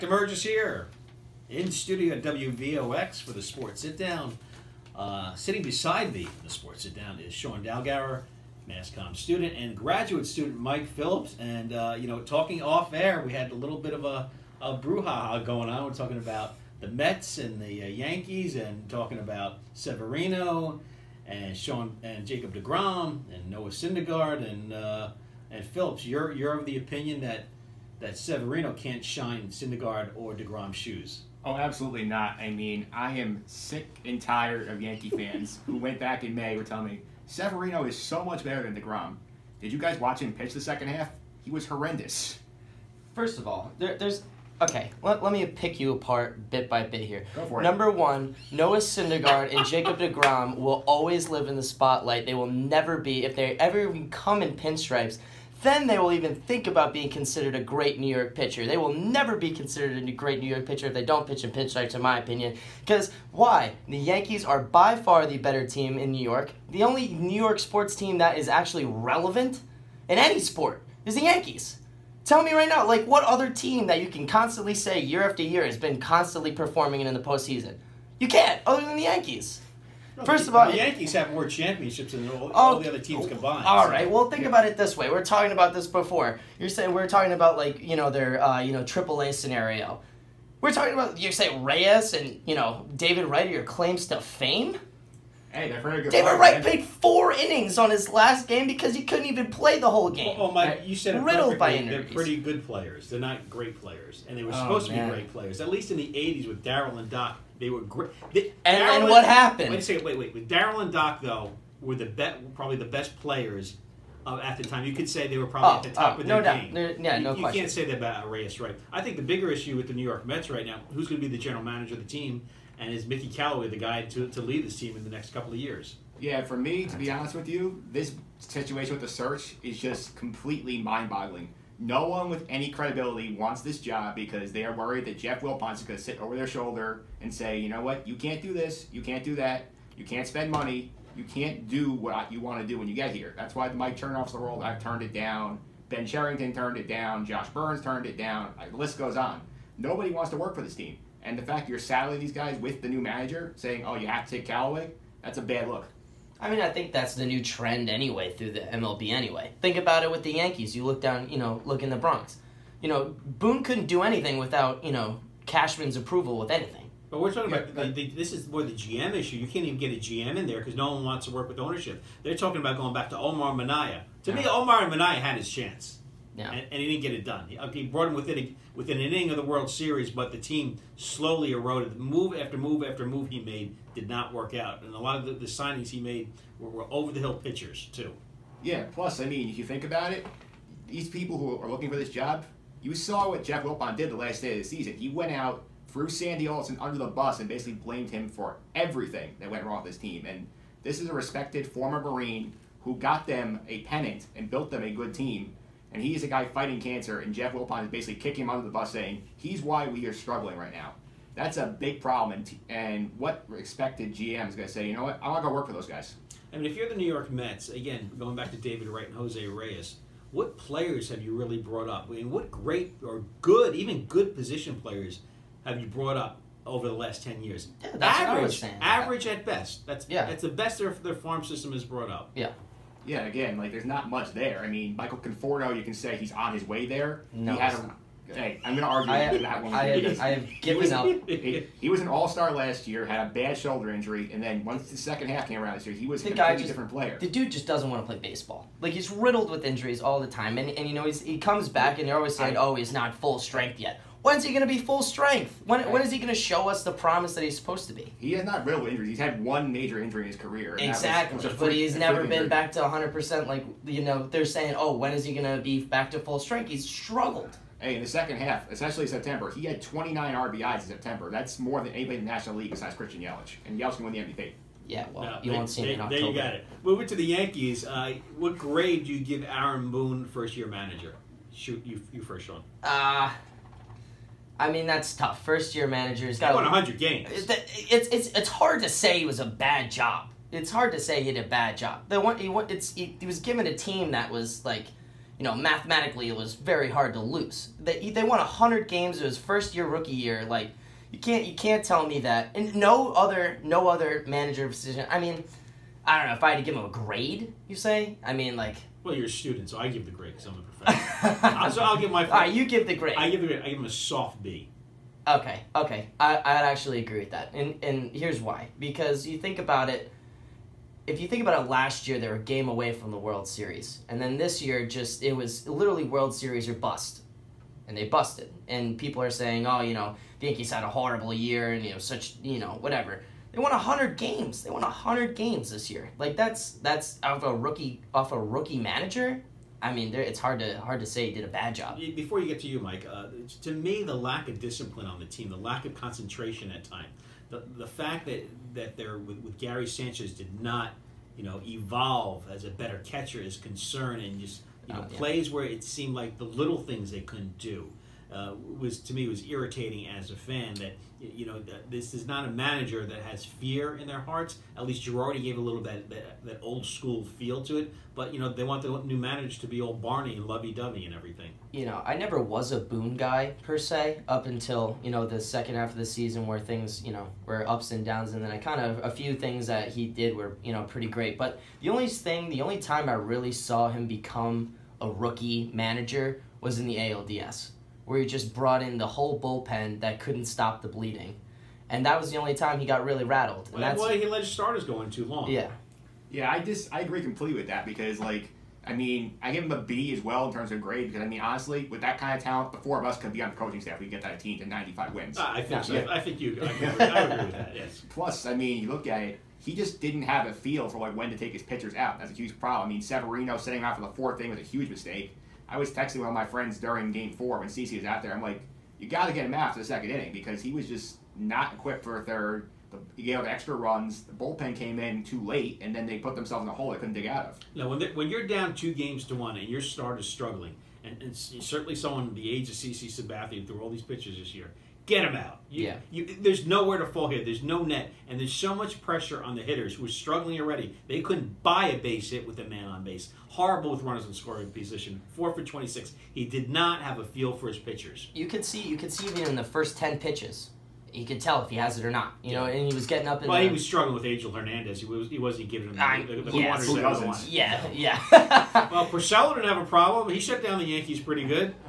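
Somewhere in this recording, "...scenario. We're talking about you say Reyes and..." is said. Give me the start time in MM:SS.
01:29.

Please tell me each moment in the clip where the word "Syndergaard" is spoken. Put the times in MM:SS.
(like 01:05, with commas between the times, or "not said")
00:23, 00:29, 00:48.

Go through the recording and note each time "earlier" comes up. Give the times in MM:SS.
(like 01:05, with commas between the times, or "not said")
not said.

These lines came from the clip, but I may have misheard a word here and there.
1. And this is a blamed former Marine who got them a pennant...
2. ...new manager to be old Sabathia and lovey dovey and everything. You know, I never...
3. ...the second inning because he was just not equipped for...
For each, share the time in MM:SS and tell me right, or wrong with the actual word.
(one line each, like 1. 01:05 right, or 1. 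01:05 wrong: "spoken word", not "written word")
1. 03:20 wrong: "respected", not "blamed"
2. 06:09 wrong: "Barney", not "Sabathia"
3. 06:59 right.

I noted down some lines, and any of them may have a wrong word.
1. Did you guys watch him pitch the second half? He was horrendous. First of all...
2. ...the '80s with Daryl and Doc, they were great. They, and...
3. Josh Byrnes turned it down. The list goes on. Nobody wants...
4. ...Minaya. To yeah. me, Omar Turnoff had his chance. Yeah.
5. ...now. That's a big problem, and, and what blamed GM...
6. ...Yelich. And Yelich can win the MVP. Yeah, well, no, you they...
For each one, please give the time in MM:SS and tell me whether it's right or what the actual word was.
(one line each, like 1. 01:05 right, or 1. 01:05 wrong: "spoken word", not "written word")
1. 00:39 right
2. 01:45 right
3. 02:27 right
4. 02:53 wrong: "Minaya", not "Turnoff"
5. 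03:30 wrong: "expected", not "blamed"
6. 04:33 right.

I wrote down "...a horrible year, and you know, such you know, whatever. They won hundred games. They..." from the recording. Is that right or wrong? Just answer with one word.
right.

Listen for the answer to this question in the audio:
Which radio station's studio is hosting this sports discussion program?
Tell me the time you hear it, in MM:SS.
00:02.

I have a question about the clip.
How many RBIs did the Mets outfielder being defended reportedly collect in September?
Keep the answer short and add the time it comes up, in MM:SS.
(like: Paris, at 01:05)
29, at 04:29.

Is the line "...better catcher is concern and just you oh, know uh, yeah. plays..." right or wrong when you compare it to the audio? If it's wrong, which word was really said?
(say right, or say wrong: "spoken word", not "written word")
right.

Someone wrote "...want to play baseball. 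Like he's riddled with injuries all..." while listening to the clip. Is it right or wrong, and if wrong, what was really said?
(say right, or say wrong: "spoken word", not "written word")
right.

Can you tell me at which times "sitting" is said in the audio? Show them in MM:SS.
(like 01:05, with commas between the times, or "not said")
00:05, 06:53.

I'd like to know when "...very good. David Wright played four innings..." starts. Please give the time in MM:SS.
01:35.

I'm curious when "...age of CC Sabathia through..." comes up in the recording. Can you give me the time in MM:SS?
07:12.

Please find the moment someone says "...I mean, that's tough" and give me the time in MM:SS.
04:44.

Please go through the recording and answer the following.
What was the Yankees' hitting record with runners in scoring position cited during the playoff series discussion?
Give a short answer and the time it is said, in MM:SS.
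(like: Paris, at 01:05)
4 for 26, at 07:25.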